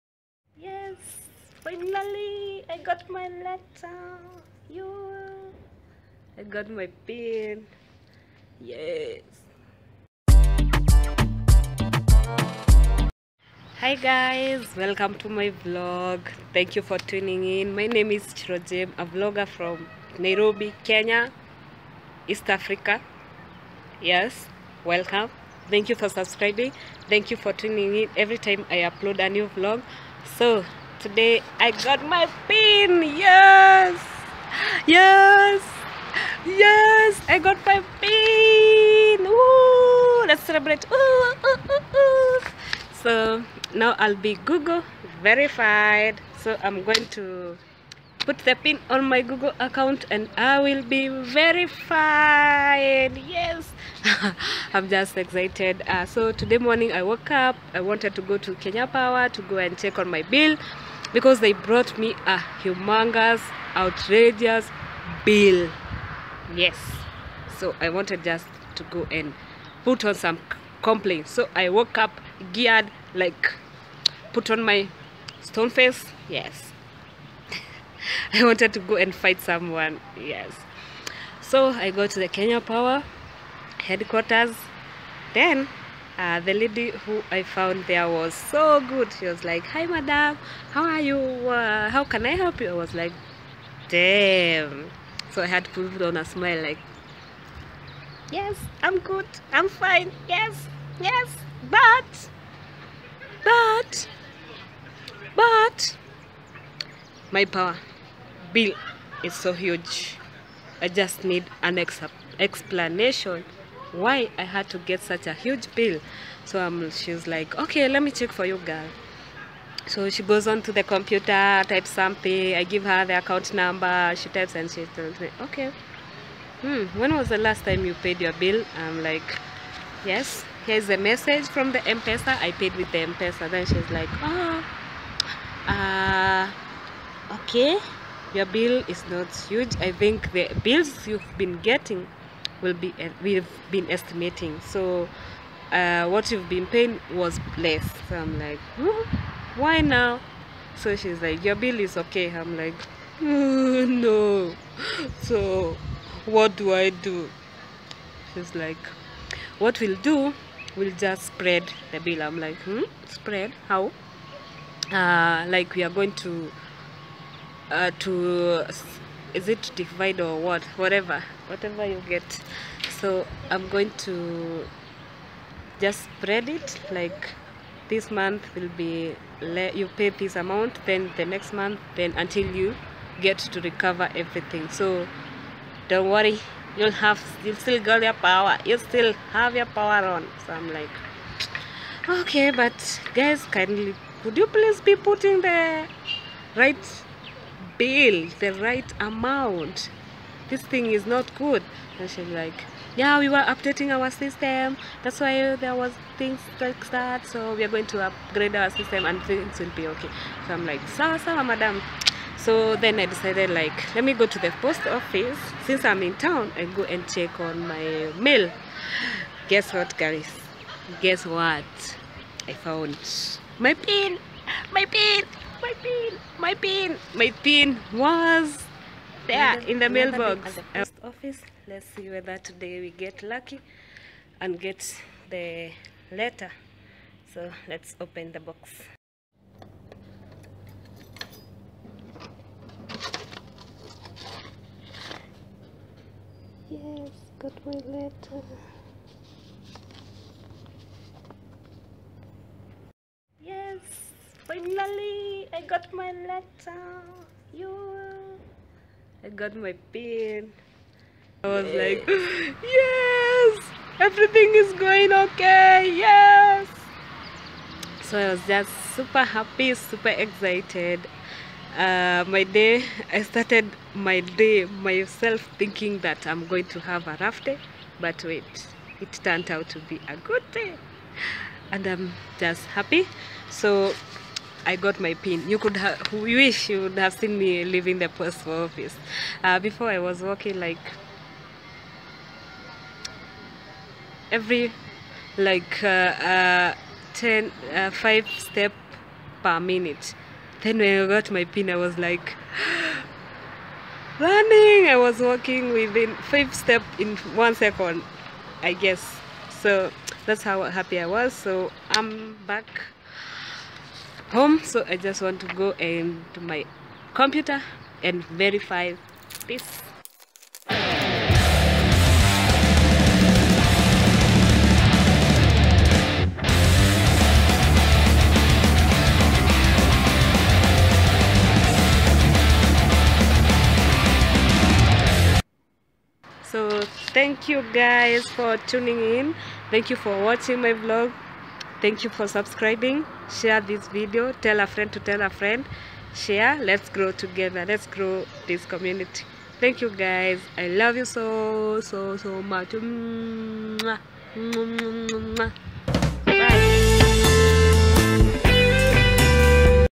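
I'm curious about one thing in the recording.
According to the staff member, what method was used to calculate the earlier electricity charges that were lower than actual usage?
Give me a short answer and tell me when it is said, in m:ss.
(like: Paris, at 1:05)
Estimating, at 2:23.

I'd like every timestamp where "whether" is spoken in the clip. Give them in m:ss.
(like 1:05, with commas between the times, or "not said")
3:52.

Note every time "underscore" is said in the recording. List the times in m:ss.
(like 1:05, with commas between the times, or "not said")
not said.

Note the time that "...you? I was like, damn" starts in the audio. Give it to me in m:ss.
1:32.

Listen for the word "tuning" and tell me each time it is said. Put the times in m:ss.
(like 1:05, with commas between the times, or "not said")
0:16, 0:27, 5:38.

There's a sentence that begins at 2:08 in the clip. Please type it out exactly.
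I'm like, yes, here's a message from the M-Pesa.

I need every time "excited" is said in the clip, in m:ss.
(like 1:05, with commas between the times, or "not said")
0:55, 4:30.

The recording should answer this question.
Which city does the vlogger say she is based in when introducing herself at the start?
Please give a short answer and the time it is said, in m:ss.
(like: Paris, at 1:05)
Nairobi, at 0:20.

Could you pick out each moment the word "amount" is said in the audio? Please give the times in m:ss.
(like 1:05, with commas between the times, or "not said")
3:00, 3:19.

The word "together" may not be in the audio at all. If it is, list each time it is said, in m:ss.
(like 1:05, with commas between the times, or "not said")
5:47.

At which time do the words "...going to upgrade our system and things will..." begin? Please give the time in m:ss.
3:27.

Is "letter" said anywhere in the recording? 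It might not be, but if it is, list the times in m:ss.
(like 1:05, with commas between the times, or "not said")
0:03, 3:56, 4:07, 4:16.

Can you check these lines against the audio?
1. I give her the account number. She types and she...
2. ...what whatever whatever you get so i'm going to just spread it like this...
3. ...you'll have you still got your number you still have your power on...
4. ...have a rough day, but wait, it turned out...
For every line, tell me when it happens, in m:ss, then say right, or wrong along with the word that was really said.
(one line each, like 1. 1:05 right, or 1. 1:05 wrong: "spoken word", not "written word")
1. 2:02 right
2. 2:50 right
3. 3:06 wrong: "power", not "number"
4. 4:36 right.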